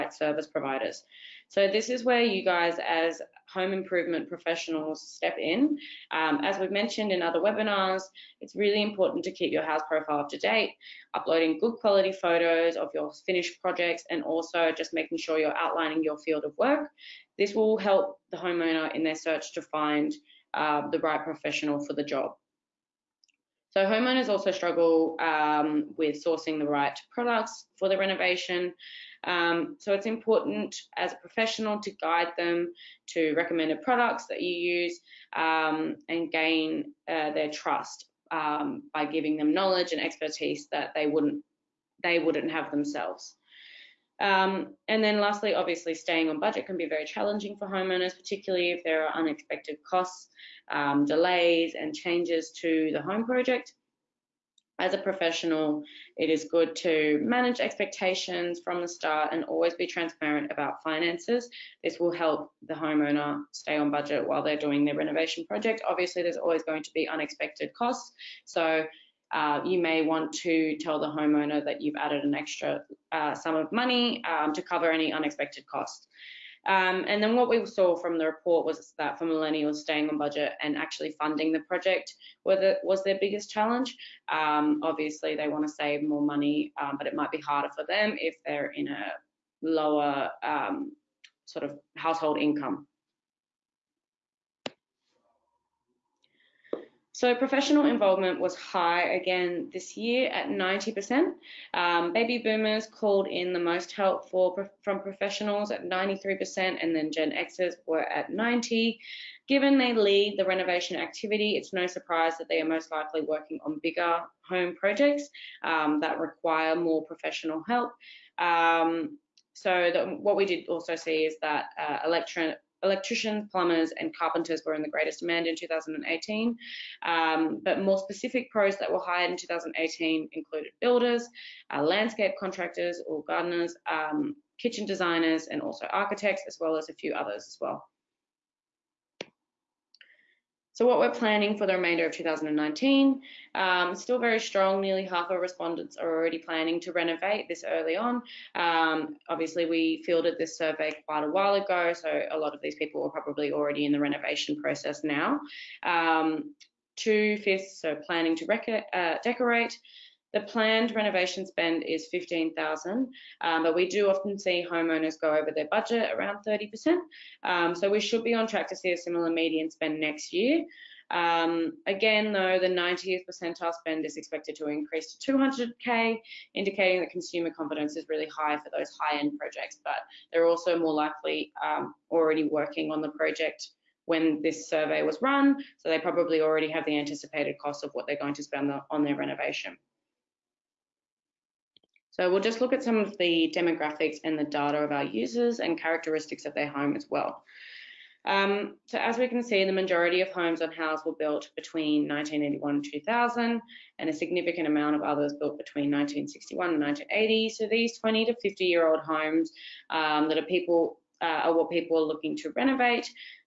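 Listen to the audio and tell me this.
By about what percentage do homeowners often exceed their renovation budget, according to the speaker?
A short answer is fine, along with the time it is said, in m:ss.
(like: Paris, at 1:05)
30%, at 2:46.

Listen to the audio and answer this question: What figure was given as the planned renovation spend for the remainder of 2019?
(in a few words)
15,000.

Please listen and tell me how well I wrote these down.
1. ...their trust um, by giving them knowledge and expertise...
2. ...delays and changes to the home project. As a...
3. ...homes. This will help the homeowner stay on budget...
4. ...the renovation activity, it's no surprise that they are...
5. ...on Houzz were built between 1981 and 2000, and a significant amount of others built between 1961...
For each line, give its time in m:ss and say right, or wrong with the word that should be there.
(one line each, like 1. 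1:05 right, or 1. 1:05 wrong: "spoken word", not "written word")
1. 0:37 right
2. 0:51 right
3. 1:00 wrong: "finances", not "homes"
4. 1:50 right
5. 3:20 right.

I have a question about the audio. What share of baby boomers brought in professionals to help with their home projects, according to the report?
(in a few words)
93%.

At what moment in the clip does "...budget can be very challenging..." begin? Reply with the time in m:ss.
0:46.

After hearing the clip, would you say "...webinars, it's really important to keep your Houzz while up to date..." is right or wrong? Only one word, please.
wrong.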